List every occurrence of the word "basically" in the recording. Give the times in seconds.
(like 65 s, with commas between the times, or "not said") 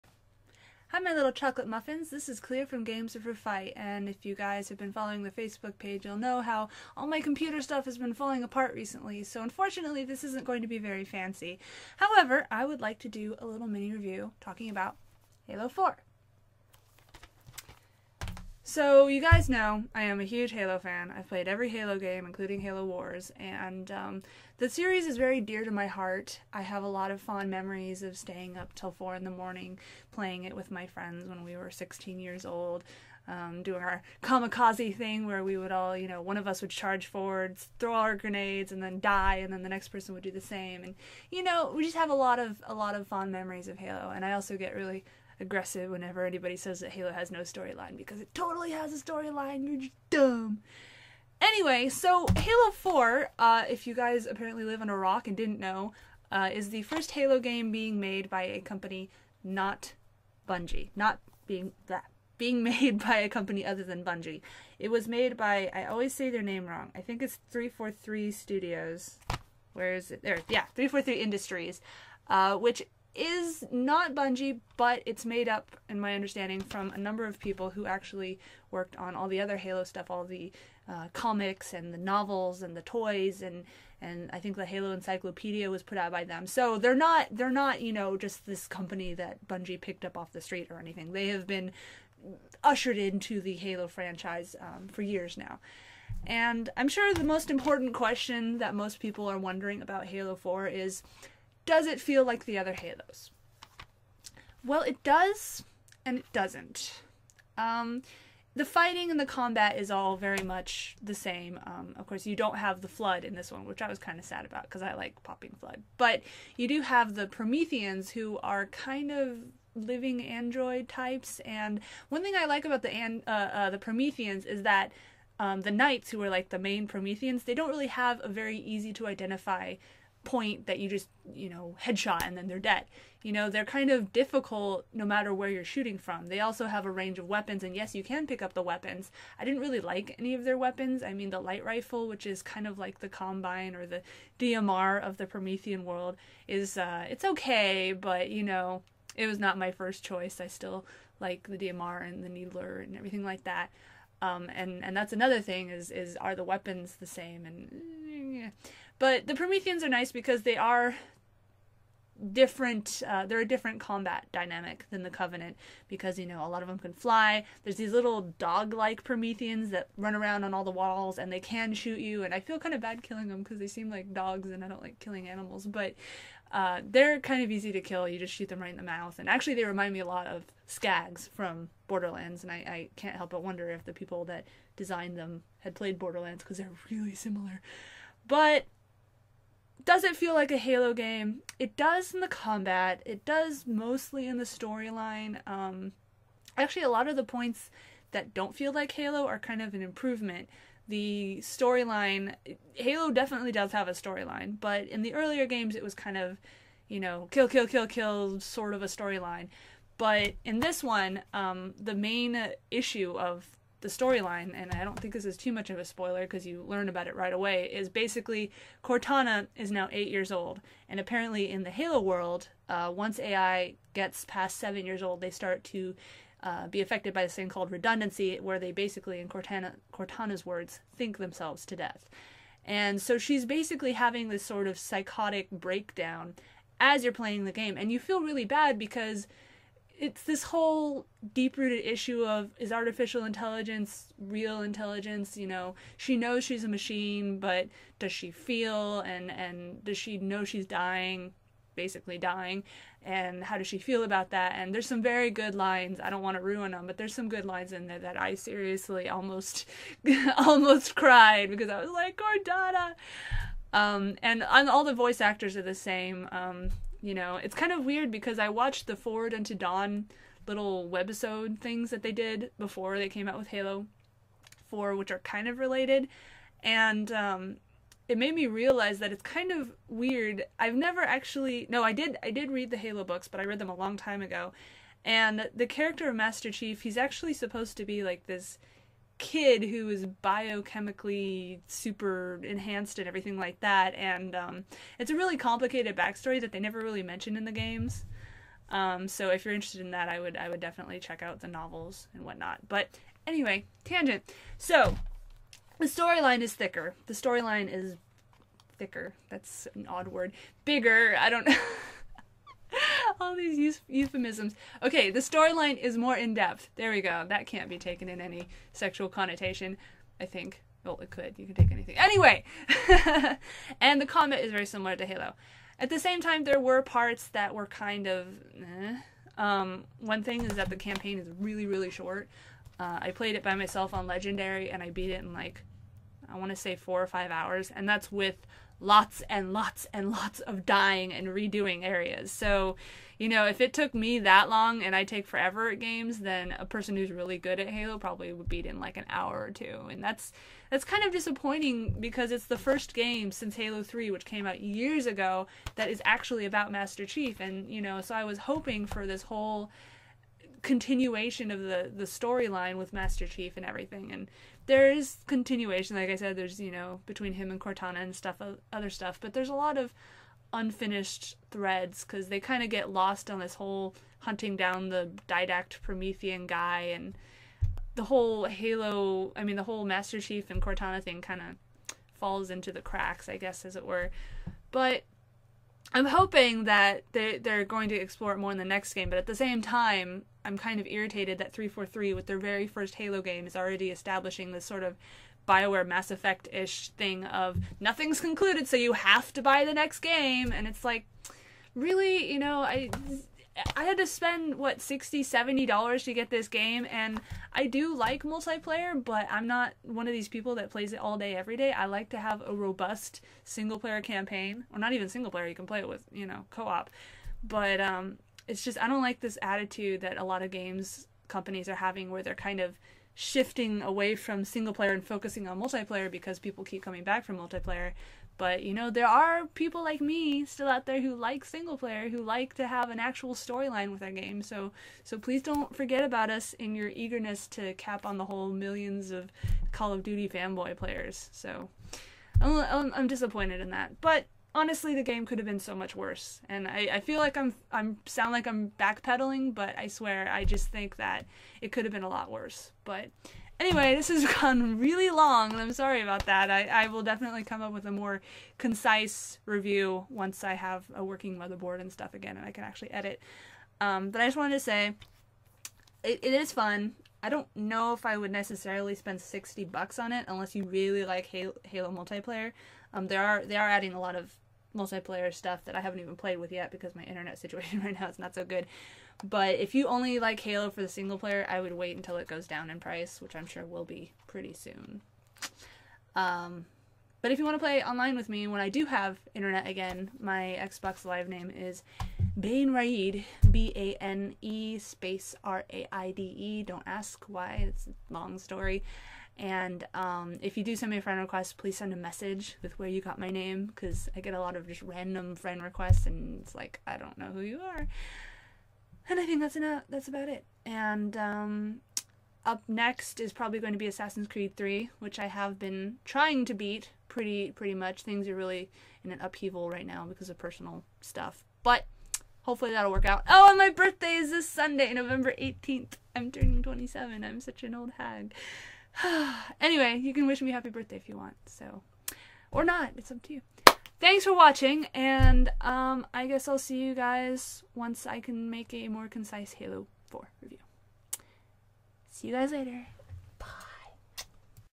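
217 s, 228 s, 233 s, 251 s.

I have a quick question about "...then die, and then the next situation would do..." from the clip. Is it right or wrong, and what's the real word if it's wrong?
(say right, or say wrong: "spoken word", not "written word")
wrong: "person", not "situation".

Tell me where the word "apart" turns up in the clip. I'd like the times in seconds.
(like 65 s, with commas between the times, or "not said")
8 s.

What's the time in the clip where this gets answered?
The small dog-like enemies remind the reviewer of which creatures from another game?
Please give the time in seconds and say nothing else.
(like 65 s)
180 s.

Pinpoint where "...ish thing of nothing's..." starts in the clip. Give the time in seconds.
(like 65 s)
396 s.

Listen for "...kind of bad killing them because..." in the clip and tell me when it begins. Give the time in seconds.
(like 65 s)
172 s.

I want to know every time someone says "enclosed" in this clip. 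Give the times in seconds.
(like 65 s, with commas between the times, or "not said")
not said.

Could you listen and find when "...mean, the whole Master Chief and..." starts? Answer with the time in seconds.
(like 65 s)
379 s.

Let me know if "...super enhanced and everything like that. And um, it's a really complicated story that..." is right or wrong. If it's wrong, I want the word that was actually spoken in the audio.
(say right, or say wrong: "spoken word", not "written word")
wrong: "backstory", not "story".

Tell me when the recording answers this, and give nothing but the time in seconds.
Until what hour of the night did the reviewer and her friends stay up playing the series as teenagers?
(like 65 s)
28 s.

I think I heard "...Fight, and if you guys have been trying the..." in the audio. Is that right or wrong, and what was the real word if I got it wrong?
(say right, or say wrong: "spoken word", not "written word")
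wrong: "following", not "trying".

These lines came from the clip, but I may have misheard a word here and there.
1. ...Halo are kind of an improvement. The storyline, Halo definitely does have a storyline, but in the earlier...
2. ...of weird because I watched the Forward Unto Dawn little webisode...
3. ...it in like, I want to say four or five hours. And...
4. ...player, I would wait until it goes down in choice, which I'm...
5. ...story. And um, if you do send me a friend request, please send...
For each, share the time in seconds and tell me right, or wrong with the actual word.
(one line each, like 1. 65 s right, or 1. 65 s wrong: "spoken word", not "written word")
1. 198 s right
2. 267 s right
3. 335 s right
4. 481 s wrong: "price", not "choice"
5. 498 s right.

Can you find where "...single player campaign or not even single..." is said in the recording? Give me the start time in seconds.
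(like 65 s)
413 s.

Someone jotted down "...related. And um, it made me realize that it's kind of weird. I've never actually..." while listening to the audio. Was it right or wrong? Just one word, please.
right.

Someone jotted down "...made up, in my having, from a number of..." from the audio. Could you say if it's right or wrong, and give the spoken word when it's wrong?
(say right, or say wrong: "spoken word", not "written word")
wrong: "understanding", not "having".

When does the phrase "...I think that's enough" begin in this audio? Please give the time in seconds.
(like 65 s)
509 s.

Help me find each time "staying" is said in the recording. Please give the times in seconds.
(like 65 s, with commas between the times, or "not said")
28 s.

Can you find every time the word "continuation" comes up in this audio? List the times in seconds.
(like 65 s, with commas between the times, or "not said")
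360 s, 365 s.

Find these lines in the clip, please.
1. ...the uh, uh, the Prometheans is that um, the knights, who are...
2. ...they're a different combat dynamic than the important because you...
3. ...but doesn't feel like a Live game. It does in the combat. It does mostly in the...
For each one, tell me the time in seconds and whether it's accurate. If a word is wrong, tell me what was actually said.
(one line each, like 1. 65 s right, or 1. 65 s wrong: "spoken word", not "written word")
1. 122 s right
2. 163 s wrong: "covenant", not "important"
3. 188 s wrong: "Halo", not "Live".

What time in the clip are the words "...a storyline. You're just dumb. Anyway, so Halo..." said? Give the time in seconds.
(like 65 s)
48 s.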